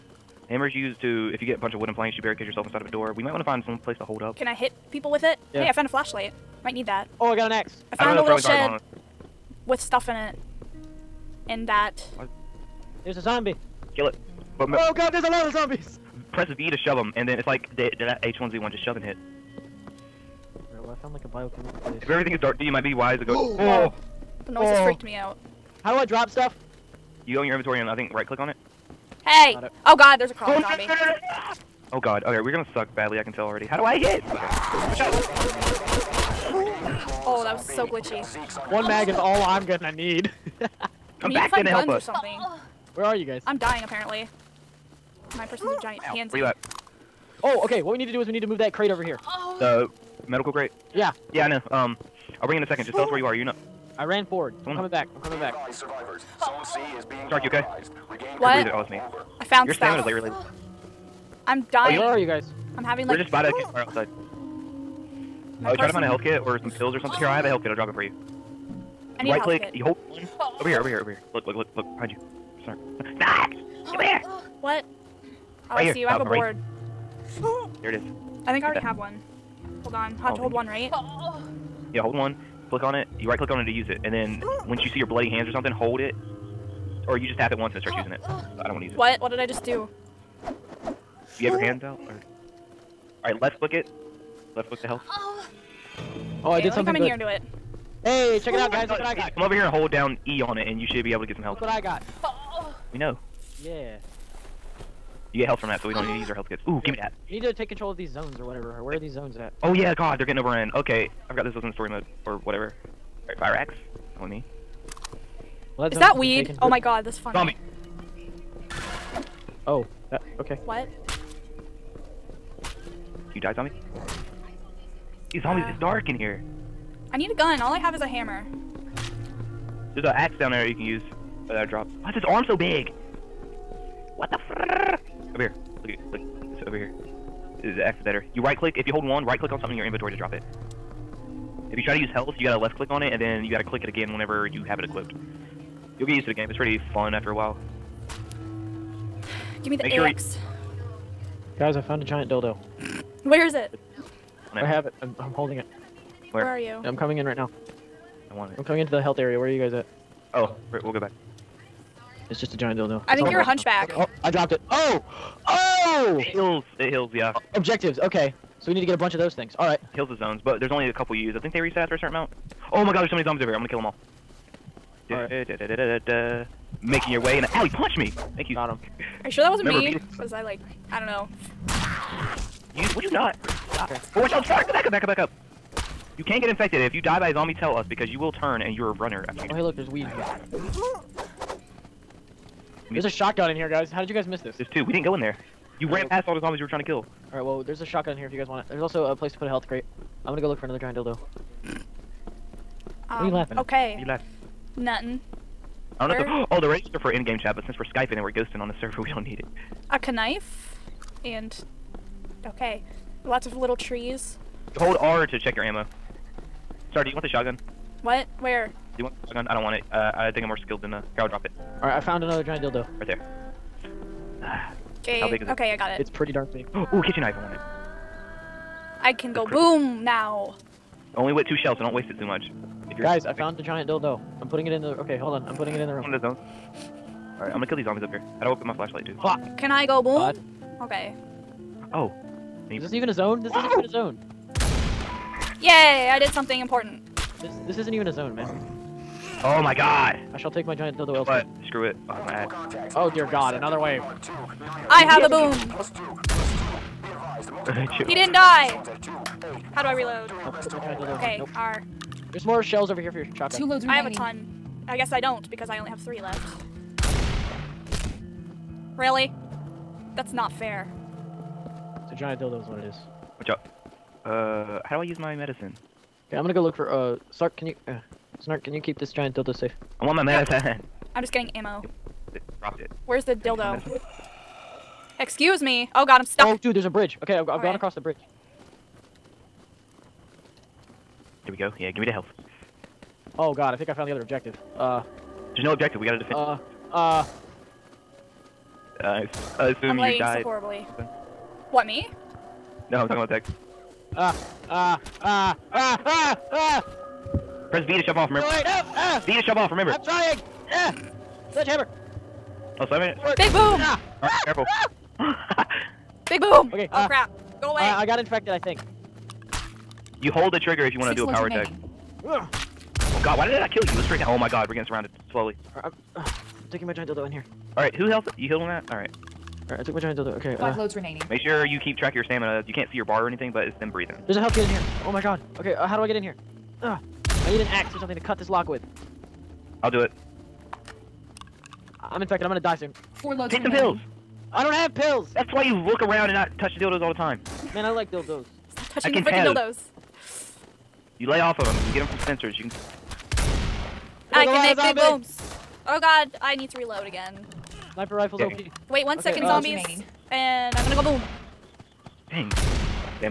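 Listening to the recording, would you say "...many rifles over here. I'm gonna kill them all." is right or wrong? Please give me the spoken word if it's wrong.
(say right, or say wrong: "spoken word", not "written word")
wrong: "zombies", not "rifles".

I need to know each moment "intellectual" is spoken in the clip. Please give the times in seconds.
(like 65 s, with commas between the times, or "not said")
not said.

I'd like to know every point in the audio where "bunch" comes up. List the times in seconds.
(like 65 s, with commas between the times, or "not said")
1 s, 168 s.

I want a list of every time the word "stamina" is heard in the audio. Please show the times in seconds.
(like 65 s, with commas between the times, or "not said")
59 s, 332 s.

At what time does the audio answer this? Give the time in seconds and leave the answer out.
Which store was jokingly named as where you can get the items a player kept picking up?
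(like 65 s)
351 s.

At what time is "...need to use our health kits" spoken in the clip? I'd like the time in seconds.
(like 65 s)
106 s.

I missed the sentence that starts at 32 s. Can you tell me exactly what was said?
Okay, we're gonna suck badly, I can tell already.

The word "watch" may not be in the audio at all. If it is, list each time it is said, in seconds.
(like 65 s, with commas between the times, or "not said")
184 s, 273 s.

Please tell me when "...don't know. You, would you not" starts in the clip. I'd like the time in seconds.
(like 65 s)
180 s.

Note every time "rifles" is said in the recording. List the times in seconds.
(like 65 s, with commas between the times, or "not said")
358 s.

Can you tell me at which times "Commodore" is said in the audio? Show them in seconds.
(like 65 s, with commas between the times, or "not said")
not said.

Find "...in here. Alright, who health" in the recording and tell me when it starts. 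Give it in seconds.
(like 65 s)
327 s.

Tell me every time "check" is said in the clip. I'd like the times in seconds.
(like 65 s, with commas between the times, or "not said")
98 s, 215 s.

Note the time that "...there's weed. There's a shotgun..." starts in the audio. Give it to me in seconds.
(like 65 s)
189 s.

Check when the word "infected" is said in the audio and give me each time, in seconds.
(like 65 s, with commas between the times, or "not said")
186 s, 318 s, 342 s.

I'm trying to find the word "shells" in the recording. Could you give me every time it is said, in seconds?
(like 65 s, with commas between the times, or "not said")
231 s, 262 s.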